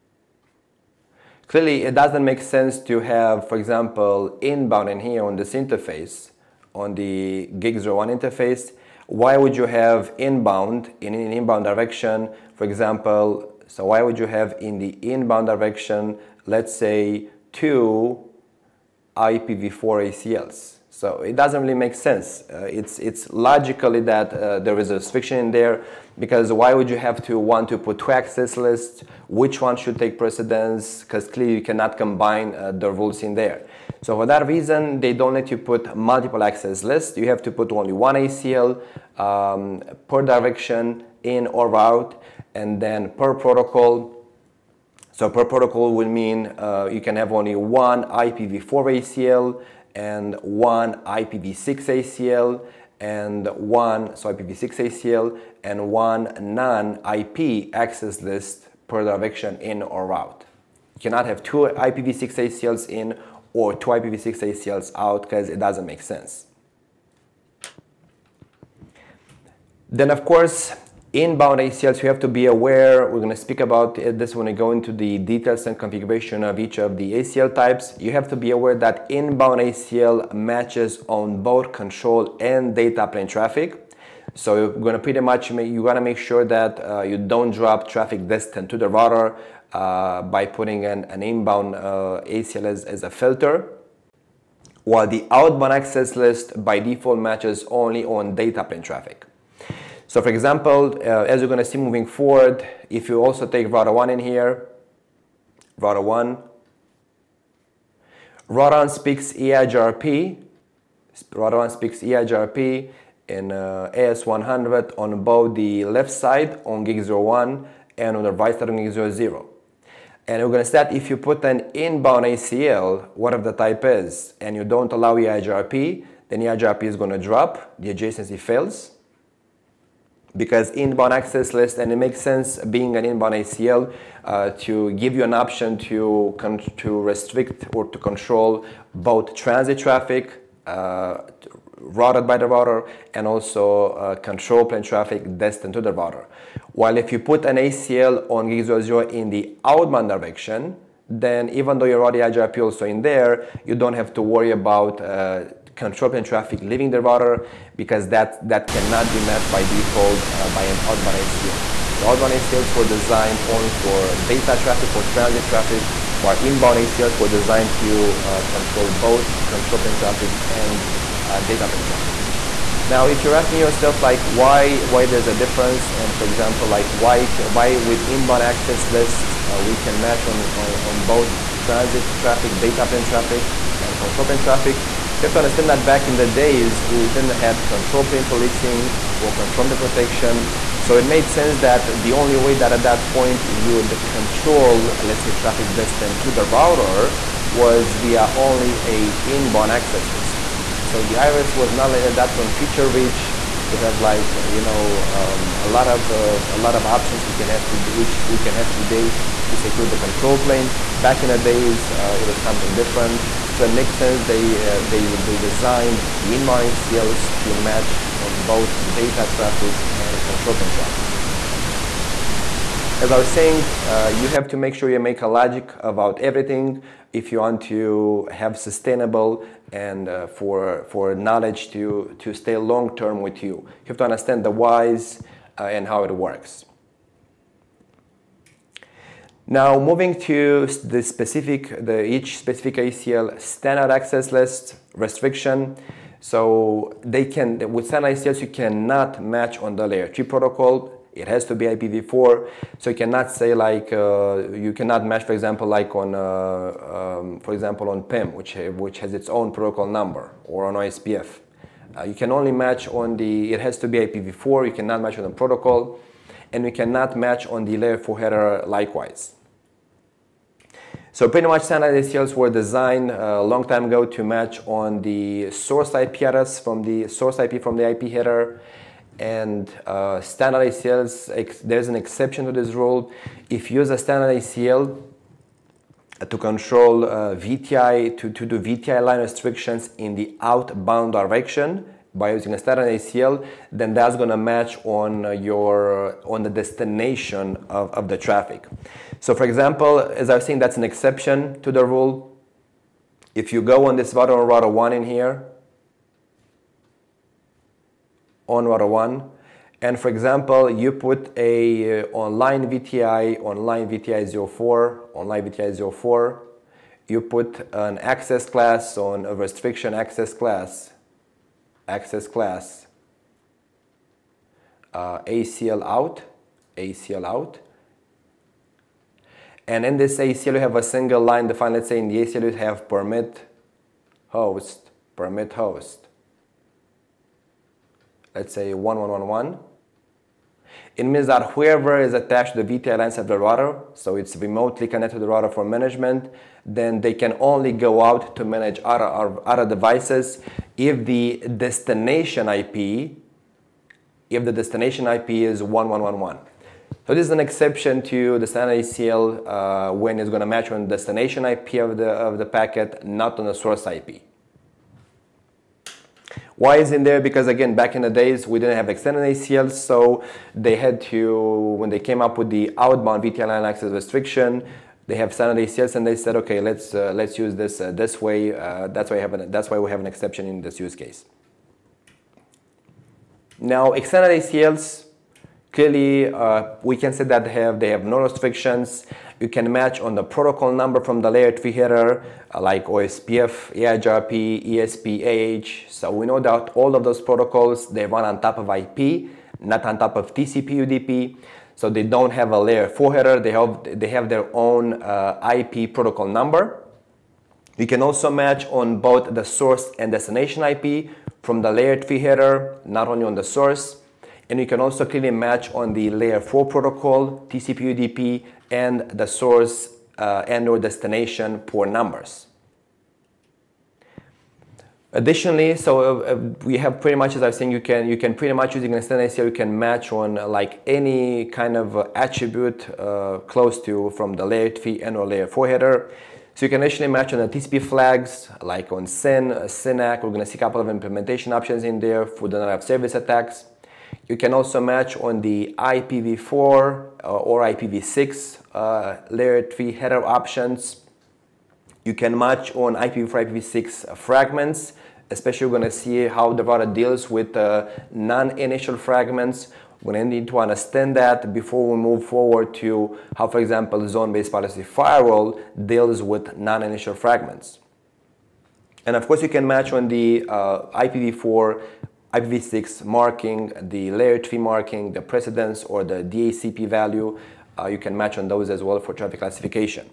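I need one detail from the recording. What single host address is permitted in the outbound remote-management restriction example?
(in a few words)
1.1.1.1.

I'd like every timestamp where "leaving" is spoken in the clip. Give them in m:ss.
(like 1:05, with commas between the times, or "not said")
2:36.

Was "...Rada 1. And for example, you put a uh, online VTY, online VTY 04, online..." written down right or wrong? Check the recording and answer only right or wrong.
right.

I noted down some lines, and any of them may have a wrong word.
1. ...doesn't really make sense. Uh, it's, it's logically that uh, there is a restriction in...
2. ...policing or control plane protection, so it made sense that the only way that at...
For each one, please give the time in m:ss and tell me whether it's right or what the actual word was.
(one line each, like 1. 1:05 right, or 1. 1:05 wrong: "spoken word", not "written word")
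1. 0:21 right
2. 3:08 right.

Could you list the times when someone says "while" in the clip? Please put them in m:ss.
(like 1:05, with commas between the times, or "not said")
1:34, 2:26, 2:46.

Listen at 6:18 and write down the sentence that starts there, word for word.
Uh, that's, why an, that's why we have an exception in this use case.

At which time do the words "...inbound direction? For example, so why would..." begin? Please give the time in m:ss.
0:11.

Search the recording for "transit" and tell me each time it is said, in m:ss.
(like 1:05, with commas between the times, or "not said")
2:19, 2:45, 3:01.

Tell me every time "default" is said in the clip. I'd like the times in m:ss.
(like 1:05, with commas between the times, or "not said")
1:36, 2:39.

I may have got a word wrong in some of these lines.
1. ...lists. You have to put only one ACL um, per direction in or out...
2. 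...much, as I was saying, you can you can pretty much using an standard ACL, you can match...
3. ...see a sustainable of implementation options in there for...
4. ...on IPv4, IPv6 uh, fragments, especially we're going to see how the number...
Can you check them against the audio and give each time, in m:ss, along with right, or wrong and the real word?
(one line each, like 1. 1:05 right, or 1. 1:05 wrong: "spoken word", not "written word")
1. 0:36 right
2. 7:07 right
3. 7:20 wrong: "couple", not "sustainable"
4. 7:32 wrong: "router", not "number".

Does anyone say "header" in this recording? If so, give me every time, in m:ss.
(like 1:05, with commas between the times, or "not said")
4:28, 4:38, 6:31, 6:43, 6:52, 7:15, 7:29.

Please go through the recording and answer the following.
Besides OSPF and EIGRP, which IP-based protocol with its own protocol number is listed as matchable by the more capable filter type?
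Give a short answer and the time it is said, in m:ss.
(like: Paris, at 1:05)
AH, at 6:35.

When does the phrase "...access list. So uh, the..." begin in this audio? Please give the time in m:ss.
3:19.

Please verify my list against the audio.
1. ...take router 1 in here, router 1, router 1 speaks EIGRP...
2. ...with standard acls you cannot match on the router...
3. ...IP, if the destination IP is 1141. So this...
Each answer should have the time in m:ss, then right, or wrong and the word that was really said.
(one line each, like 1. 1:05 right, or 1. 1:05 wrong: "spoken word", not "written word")
1. 1:43 right
2. 4:07 wrong: "layer", not "router"
3. 5:52 wrong: "1111", not "1141".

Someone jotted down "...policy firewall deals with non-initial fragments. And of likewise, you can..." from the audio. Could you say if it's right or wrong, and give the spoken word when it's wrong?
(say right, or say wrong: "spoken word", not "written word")
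wrong: "course", not "likewise".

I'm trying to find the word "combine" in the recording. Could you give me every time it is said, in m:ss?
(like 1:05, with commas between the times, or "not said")
0:31.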